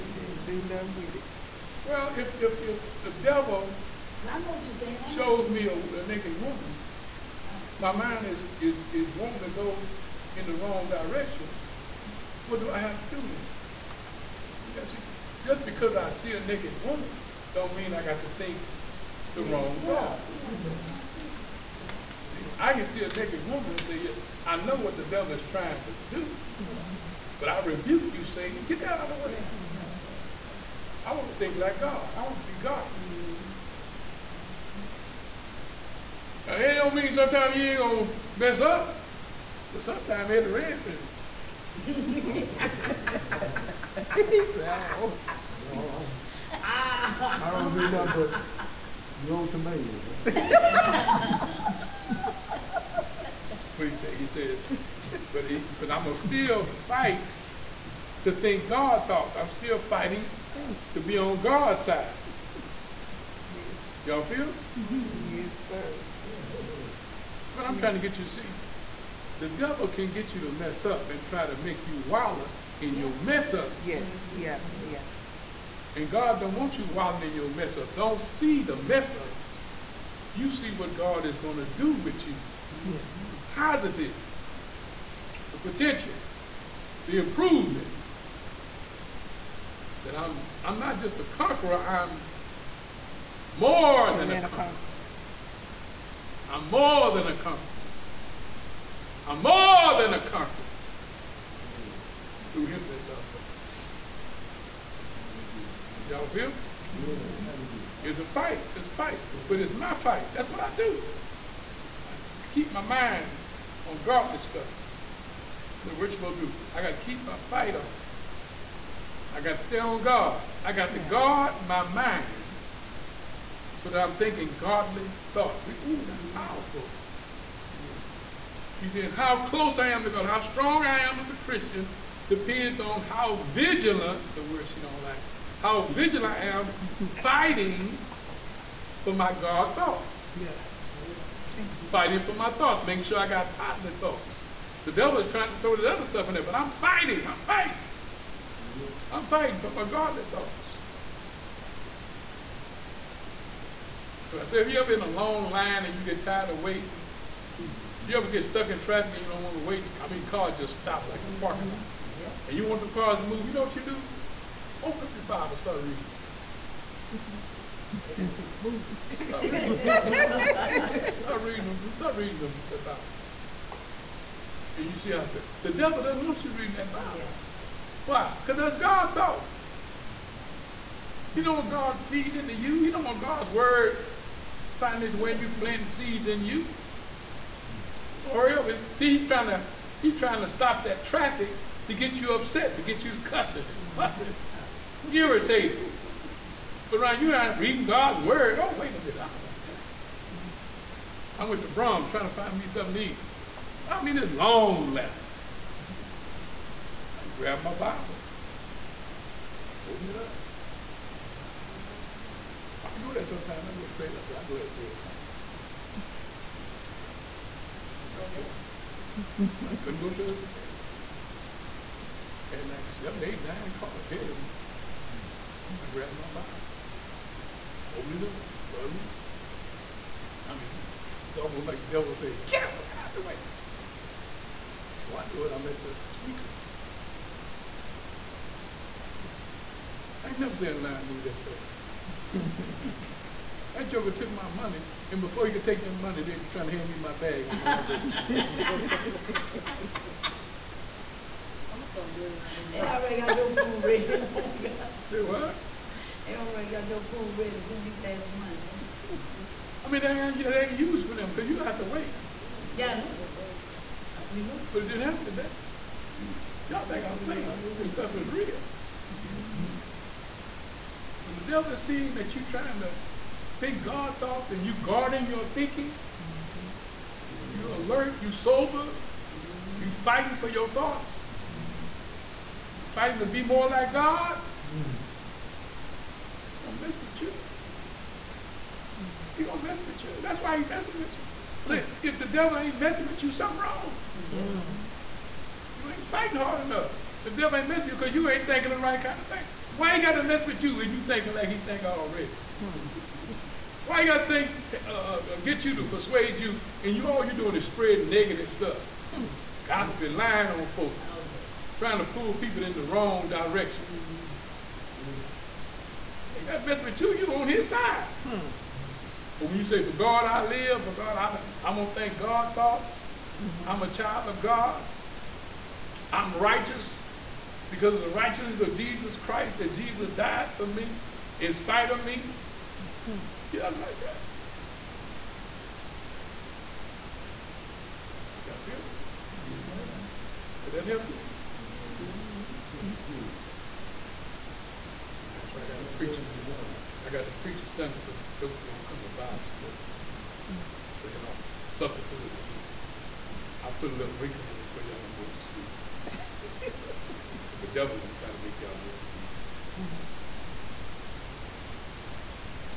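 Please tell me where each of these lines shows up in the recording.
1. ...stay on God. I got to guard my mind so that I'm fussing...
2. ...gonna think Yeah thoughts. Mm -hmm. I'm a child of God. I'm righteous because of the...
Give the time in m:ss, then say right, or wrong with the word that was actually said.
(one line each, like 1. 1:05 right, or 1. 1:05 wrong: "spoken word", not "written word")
1. 1:59 wrong: "thinking", not "fussing"
2. 5:21 wrong: "God", not "Yeah".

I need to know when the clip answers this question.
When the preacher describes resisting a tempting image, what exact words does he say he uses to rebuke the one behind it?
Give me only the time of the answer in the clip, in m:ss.
0:27.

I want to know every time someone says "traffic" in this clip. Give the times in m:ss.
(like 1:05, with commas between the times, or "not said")
2:38, 3:11.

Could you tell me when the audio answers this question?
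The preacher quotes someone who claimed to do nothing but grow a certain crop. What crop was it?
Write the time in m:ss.
0:49.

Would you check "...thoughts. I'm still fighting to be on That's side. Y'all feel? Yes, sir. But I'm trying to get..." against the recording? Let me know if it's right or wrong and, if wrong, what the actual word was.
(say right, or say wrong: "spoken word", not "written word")
wrong: "God", not "That".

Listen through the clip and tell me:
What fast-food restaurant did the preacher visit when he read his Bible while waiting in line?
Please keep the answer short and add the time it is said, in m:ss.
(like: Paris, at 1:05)
Braum's, at 3:21.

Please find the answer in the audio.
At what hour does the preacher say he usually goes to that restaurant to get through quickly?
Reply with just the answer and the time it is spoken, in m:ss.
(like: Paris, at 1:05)
3 o'clock, at 3:34.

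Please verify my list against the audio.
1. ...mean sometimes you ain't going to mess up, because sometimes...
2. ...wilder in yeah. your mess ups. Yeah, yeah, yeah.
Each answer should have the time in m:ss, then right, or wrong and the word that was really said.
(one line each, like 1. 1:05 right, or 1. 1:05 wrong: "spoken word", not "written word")
1. 0:36 right
2. 1:12 right.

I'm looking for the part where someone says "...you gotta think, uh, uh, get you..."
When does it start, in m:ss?
5:04.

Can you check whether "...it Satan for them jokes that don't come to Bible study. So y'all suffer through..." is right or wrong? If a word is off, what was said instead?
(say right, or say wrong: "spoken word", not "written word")
wrong: "Sunday", not "Satan".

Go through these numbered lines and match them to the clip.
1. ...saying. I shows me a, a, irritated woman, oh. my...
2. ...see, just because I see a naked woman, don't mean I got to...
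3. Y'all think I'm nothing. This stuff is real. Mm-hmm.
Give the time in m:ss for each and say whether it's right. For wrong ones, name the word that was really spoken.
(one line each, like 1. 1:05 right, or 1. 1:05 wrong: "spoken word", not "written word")
1. 0:04 wrong: "naked", not "irritated"
2. 0:14 right
3. 4:26 wrong: "playing", not "nothing".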